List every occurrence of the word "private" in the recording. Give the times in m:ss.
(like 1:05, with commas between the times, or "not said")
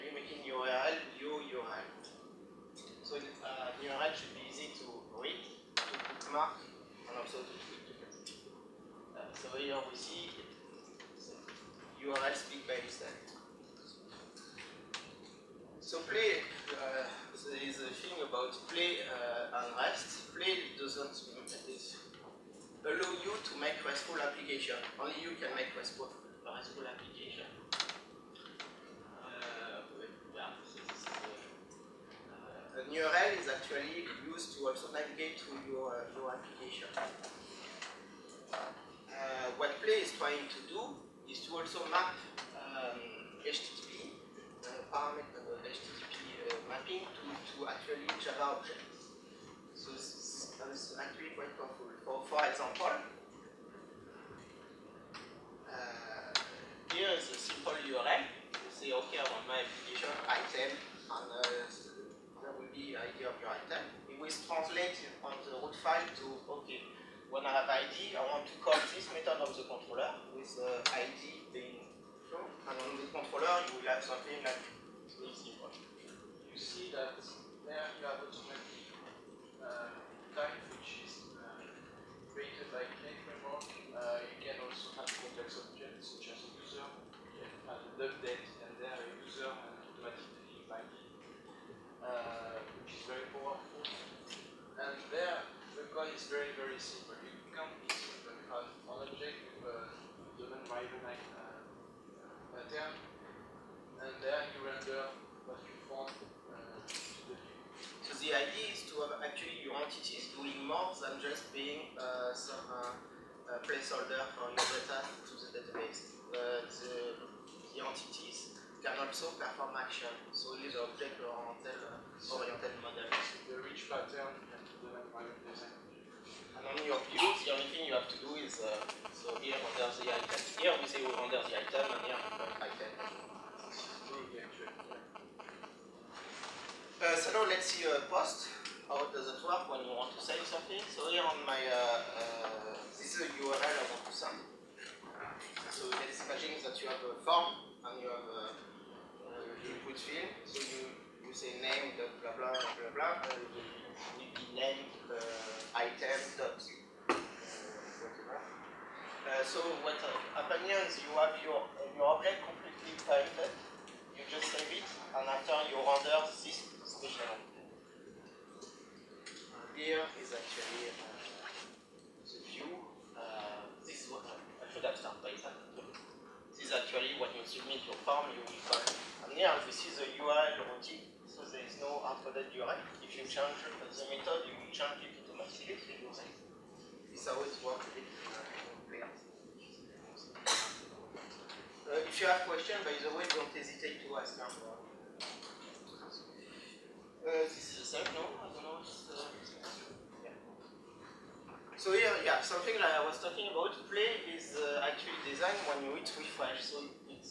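2:43.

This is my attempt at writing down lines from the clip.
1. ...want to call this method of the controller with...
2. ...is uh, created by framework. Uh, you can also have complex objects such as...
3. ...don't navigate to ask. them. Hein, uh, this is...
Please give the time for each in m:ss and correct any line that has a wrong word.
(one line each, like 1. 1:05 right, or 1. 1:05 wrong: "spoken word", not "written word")
1. 1:08 right
2. 1:21 right
3. 3:13 wrong: "hesitate", not "navigate".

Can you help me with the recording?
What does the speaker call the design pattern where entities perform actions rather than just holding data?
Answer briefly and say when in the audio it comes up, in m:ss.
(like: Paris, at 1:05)
rich pattern, at 2:03.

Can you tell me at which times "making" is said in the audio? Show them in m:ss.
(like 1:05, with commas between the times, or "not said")
0:00.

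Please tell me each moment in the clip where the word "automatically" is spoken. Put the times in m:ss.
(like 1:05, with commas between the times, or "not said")
1:18, 1:29, 3:05.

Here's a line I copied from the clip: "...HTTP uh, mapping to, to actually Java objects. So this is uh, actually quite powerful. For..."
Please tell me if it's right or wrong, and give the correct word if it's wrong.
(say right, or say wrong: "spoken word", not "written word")
right.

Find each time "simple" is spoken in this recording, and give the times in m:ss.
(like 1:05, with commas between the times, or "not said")
0:57, 1:36.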